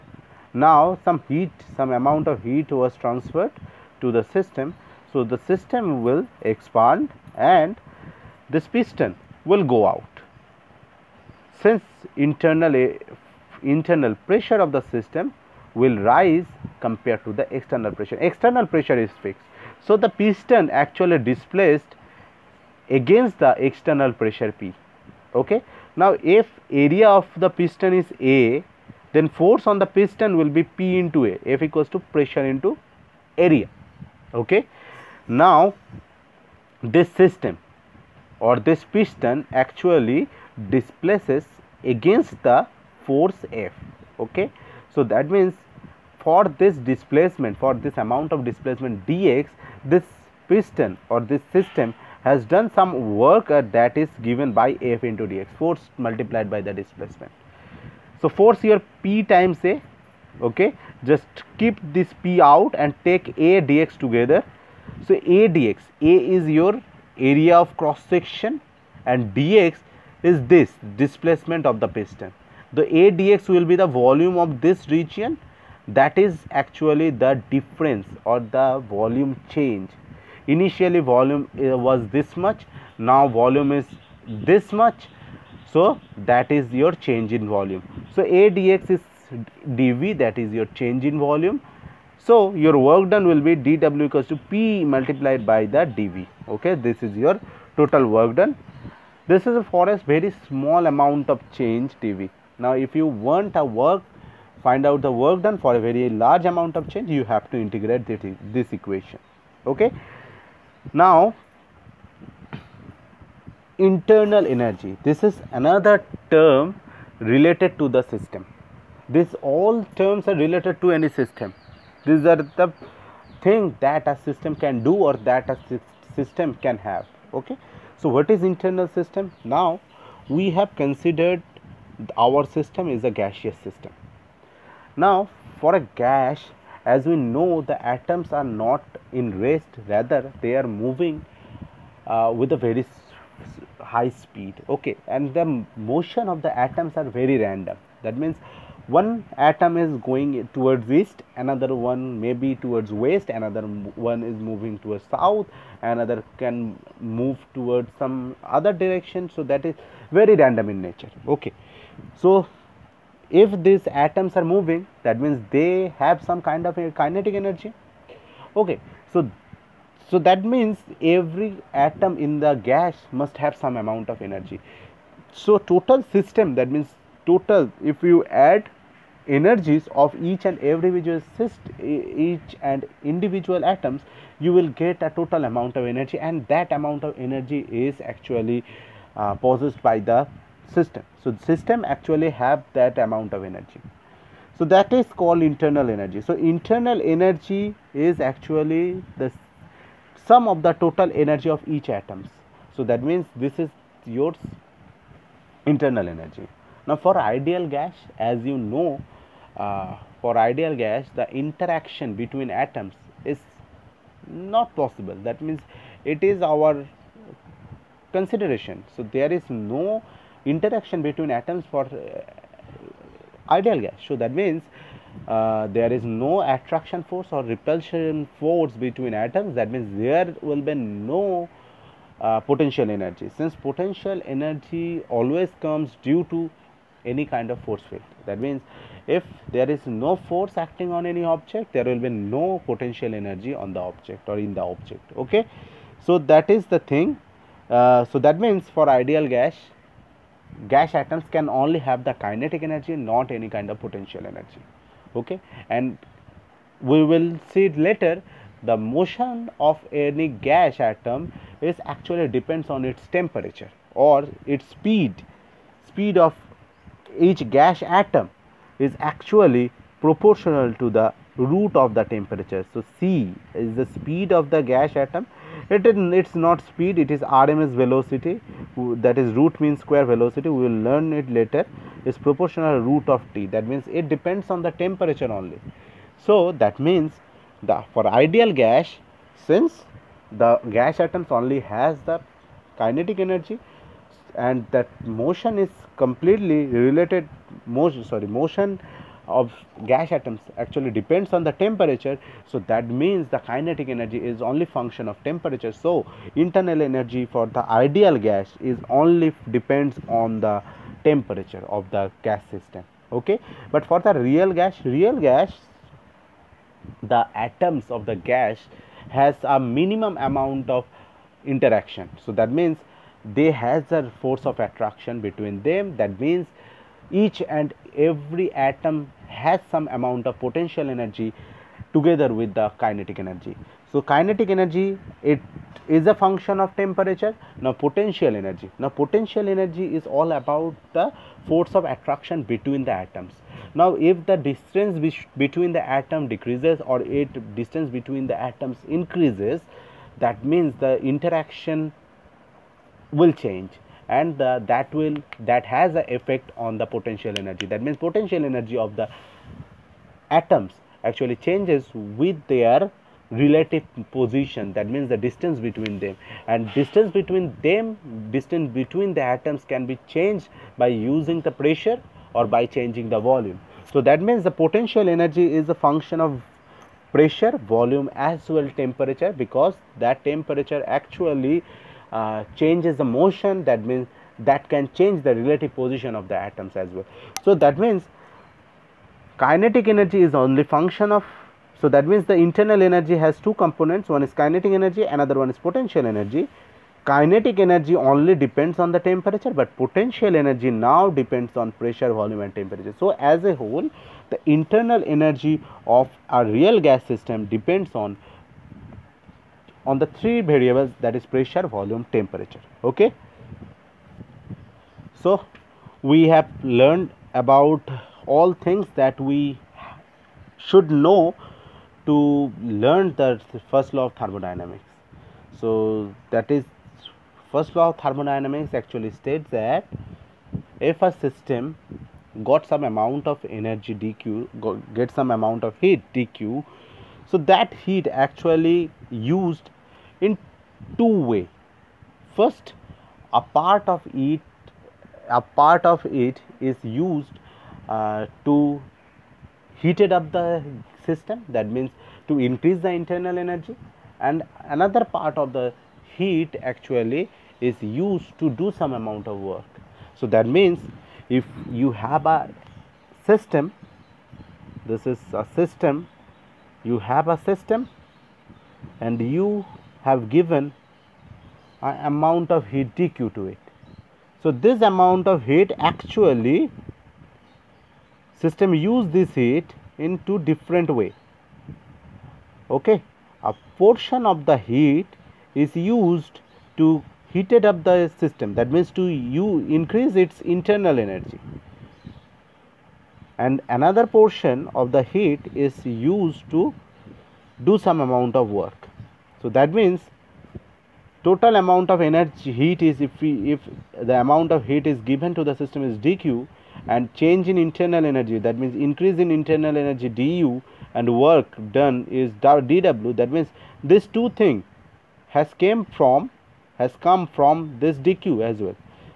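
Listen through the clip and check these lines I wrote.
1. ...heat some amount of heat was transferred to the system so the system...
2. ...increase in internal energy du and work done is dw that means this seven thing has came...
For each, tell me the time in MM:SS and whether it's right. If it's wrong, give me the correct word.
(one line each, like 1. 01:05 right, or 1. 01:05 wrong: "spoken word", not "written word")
1. 00:01 right
2. 08:28 wrong: "two", not "seven".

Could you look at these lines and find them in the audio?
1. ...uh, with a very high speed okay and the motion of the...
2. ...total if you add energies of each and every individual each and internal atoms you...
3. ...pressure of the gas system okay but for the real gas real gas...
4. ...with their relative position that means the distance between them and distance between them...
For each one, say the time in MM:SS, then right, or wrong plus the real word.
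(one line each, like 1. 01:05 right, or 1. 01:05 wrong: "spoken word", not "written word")
1. 02:22 right
2. 02:57 wrong: "individual", not "internal"
3. 05:11 wrong: "temperature", not "pressure"
4. 06:01 right.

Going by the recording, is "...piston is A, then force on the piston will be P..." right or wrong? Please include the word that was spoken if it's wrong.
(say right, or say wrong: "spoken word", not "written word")
right.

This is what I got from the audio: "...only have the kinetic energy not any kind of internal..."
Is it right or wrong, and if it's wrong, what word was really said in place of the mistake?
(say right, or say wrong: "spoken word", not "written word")
wrong: "potential", not "internal".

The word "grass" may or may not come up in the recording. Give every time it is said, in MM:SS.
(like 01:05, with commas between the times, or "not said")
not said.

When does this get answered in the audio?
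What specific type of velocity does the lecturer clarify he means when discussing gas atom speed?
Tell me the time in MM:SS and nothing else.
04:39.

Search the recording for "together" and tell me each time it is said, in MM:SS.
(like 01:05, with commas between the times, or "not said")
01:04, 05:31.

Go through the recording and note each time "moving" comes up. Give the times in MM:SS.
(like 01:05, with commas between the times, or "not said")
02:20, 02:34, 02:44.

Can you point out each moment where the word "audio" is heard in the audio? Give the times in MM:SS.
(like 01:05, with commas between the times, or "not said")
not said.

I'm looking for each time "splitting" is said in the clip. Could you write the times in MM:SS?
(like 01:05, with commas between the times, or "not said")
not said.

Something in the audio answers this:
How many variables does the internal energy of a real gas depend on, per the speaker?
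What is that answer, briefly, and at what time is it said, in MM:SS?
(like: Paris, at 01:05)
3, at 06:50.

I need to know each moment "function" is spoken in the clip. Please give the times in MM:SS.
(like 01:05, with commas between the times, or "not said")
05:04, 05:36, 06:15, 06:30.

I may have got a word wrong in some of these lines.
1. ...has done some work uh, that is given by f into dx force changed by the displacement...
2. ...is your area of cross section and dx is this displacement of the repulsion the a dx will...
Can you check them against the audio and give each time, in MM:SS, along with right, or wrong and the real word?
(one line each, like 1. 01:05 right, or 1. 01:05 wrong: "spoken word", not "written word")
1. 00:52 wrong: "multiplied", not "changed"
2. 01:06 wrong: "piston", not "repulsion".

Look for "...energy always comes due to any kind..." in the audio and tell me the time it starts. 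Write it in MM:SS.
03:54.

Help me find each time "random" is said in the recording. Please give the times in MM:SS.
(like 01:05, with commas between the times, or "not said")
02:27, 02:40.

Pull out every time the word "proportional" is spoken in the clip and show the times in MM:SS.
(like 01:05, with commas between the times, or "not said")
04:30, 04:42.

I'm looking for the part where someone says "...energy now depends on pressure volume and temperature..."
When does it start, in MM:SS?
06:40.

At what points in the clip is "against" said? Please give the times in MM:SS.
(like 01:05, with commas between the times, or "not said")
00:22, 00:41.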